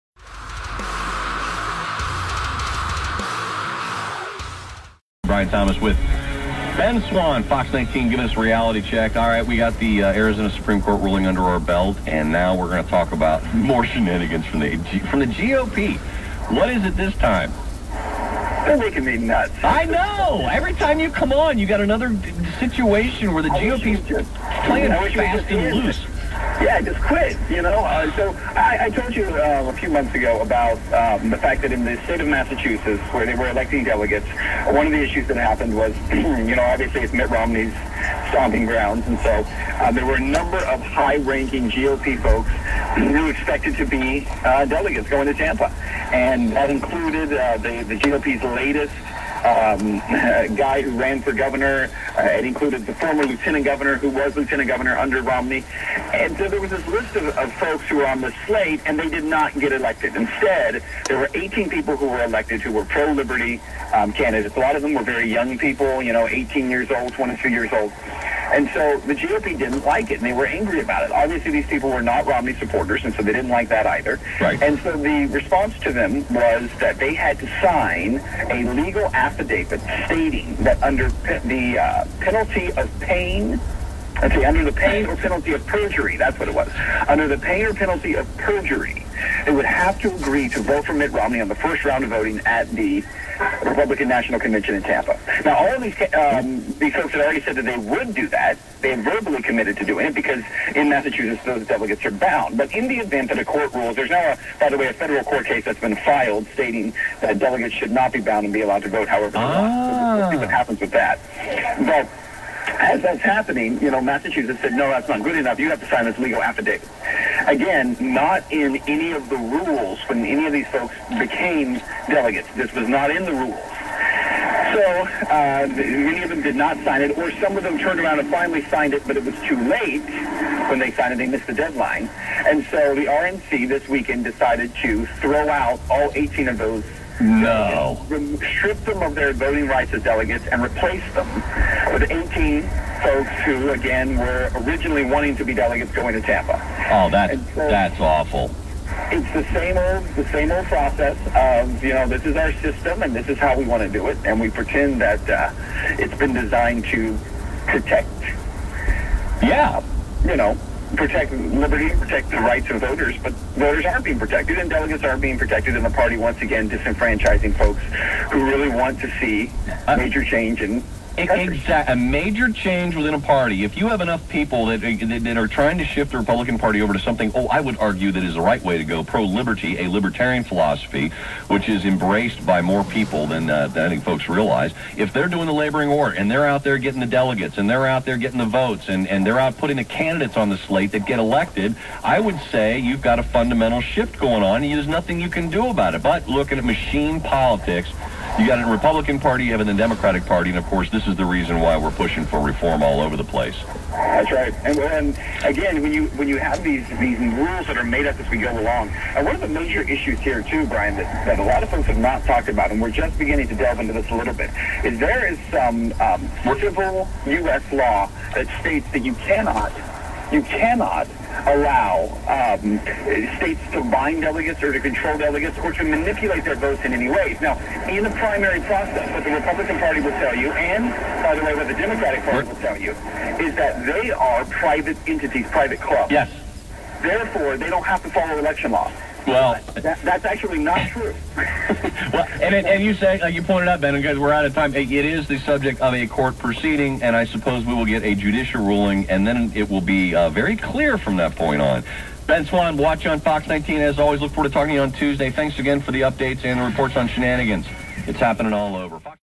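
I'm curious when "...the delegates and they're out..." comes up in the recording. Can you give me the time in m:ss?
3:07.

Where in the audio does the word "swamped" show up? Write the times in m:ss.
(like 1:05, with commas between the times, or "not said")
not said.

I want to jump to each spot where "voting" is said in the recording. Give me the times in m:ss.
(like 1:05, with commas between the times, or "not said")
1:32, 2:19.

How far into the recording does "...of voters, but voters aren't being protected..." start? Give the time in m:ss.
2:42.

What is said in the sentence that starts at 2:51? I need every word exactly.
A major change within a party.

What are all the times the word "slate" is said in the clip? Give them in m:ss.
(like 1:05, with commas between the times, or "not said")
0:58, 3:10.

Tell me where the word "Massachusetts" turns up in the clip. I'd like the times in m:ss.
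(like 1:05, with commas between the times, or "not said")
0:32, 1:40, 1:54.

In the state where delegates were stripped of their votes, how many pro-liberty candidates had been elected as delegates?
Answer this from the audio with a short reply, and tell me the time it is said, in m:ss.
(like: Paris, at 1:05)
18, at 1:01.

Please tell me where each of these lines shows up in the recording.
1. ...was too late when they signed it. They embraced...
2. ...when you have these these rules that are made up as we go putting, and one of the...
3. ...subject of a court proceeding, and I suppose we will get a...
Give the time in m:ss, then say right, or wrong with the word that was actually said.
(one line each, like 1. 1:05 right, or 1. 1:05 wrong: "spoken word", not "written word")
1. 2:09 wrong: "missed", not "embraced"
2. 3:26 wrong: "along", not "putting"
3. 4:05 right.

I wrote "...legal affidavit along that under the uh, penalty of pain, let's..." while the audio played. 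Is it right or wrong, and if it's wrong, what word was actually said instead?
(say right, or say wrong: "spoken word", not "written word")
wrong: "stating", not "along".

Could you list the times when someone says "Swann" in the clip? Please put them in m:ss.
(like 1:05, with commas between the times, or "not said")
0:07, 4:12.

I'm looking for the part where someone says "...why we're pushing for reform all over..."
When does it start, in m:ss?
3:21.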